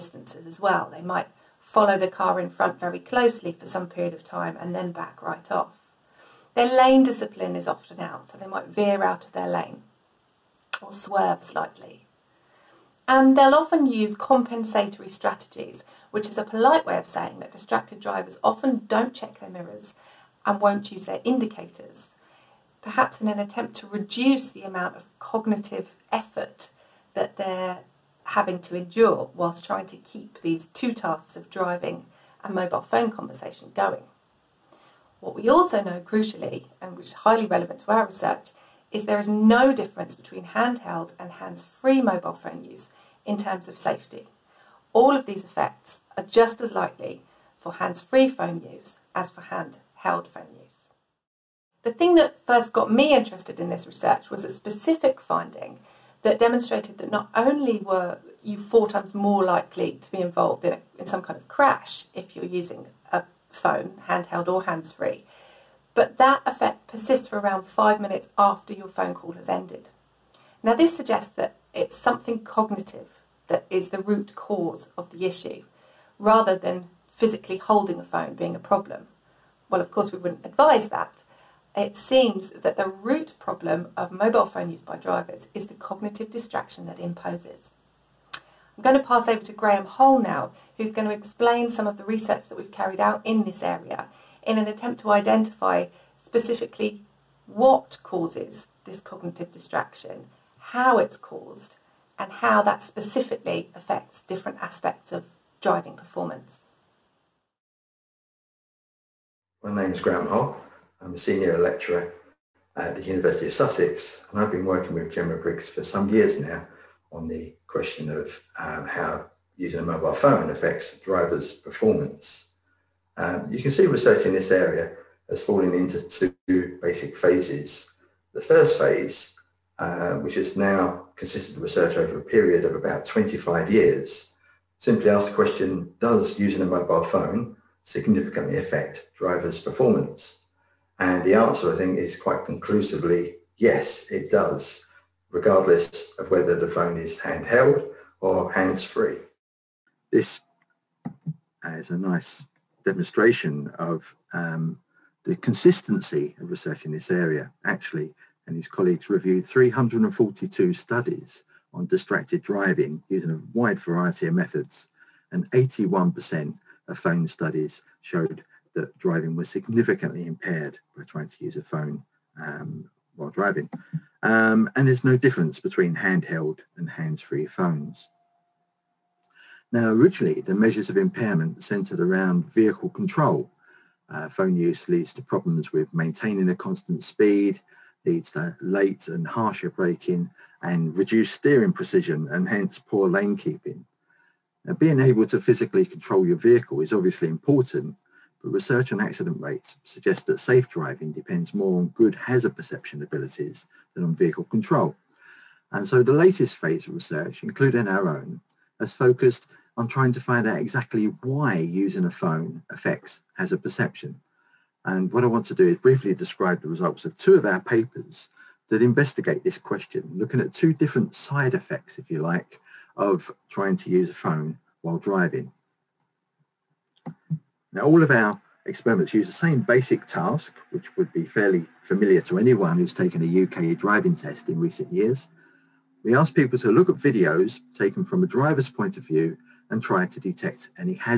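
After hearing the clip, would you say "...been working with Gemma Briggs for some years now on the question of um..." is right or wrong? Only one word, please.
right.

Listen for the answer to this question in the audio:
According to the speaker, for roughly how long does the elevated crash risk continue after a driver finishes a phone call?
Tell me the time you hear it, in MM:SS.
01:07.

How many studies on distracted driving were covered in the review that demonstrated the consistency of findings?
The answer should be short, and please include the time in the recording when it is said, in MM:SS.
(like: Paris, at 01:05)
342, at 02:39.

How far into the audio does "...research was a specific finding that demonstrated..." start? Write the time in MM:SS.
00:53.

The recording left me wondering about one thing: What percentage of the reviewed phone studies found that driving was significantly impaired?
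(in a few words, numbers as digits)
81%.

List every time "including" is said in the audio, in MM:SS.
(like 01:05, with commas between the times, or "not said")
03:27.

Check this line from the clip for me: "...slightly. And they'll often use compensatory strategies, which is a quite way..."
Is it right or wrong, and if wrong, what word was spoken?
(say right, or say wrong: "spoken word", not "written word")
wrong: "polite", not "quite".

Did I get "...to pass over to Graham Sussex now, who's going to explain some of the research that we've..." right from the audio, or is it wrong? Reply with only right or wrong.
wrong.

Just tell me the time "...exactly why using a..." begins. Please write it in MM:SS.
03:30.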